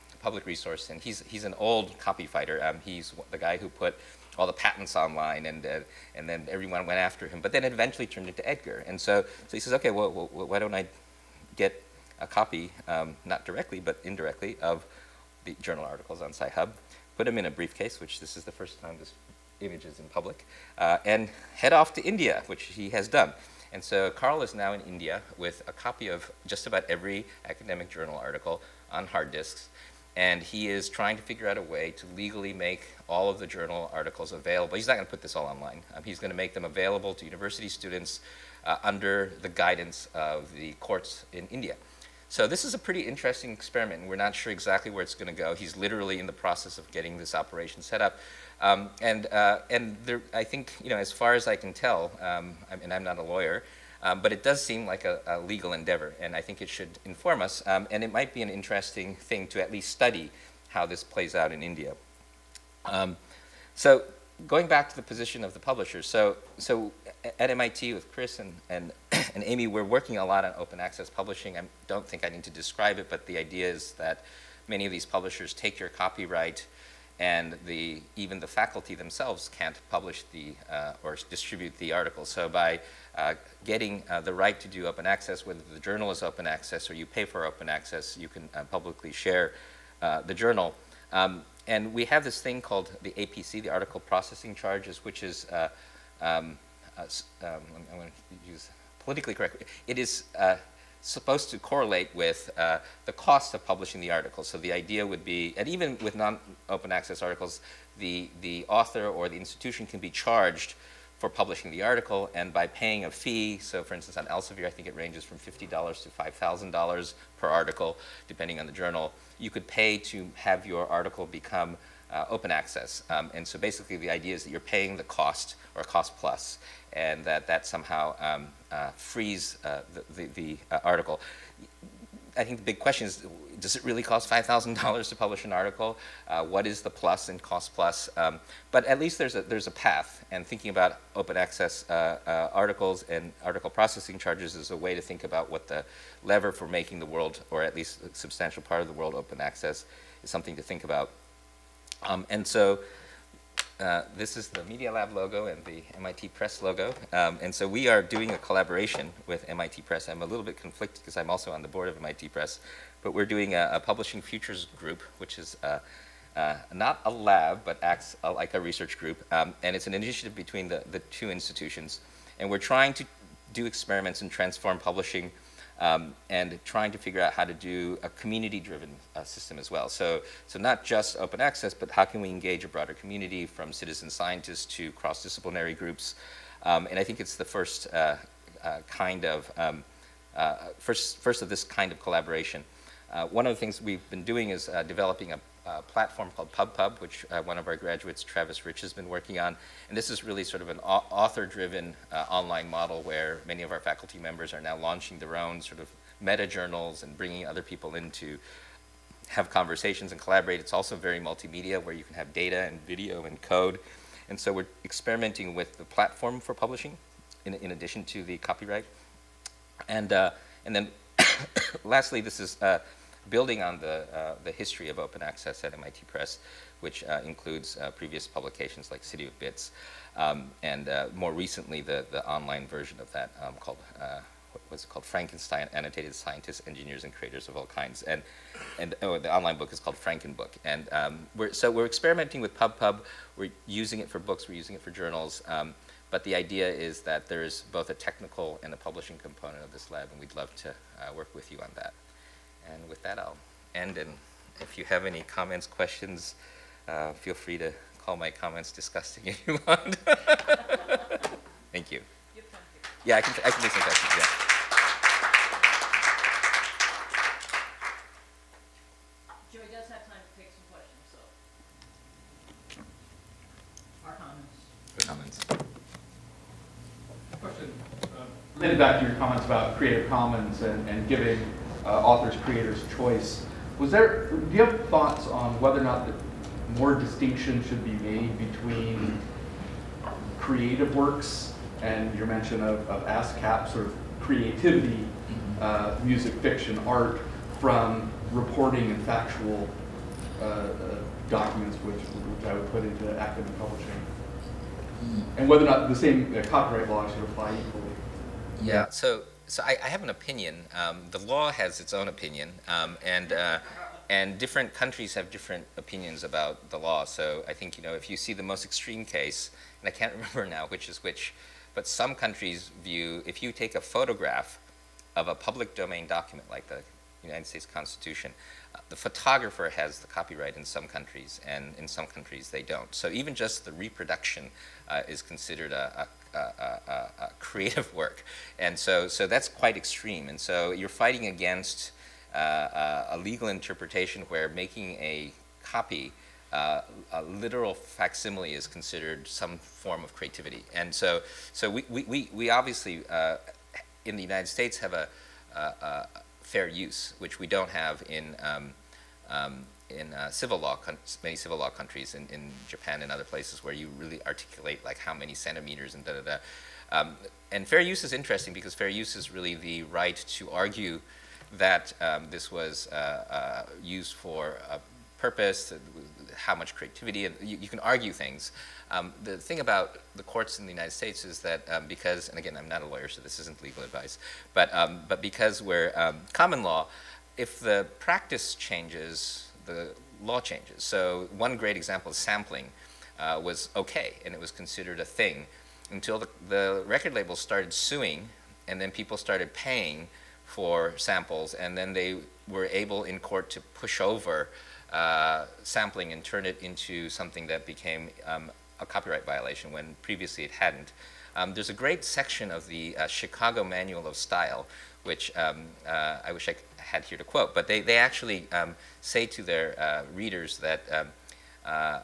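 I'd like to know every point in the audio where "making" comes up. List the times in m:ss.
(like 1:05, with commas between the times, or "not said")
2:26, 5:44.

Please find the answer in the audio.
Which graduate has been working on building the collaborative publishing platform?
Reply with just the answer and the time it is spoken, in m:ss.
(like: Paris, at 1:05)
Travis Rich, at 3:18.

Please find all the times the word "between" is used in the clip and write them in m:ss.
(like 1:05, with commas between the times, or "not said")
2:50, 4:48.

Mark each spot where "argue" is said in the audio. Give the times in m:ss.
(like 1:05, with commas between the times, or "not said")
6:10, 6:17.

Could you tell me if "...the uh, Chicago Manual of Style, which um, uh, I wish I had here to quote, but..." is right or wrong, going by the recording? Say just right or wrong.
right.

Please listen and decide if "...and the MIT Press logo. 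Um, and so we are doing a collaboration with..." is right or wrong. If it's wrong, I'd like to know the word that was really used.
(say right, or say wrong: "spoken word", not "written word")
right.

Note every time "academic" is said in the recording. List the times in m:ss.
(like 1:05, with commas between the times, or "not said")
0:27, 5:03.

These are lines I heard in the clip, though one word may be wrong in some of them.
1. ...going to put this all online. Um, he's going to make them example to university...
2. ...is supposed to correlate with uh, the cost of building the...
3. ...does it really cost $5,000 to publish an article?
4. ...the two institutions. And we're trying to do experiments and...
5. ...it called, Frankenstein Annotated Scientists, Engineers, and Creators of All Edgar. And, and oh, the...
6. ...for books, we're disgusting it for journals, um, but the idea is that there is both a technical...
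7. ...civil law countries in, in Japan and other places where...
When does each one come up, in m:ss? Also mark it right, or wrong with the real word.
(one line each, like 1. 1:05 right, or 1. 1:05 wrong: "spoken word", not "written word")
1. 0:34 wrong: "available", not "example"
2. 1:39 wrong: "publishing", not "building"
3. 2:13 right
4. 2:50 right
5. 3:54 wrong: "Kinds", not "Edgar"
6. 4:04 wrong: "using", not "disgusting"
7. 6:01 right.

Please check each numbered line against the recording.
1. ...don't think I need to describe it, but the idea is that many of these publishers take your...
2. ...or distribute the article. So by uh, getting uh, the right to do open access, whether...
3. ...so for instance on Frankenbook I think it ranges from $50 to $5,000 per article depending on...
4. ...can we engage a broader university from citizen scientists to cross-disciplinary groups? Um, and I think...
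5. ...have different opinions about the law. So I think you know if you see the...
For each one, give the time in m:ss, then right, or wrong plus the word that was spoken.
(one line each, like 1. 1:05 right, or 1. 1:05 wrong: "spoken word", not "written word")
1. 1:11 right
2. 1:21 right
3. 1:53 wrong: "Elsevier", not "Frankenbook"
4. 3:02 wrong: "community", not "university"
5. 5:15 right.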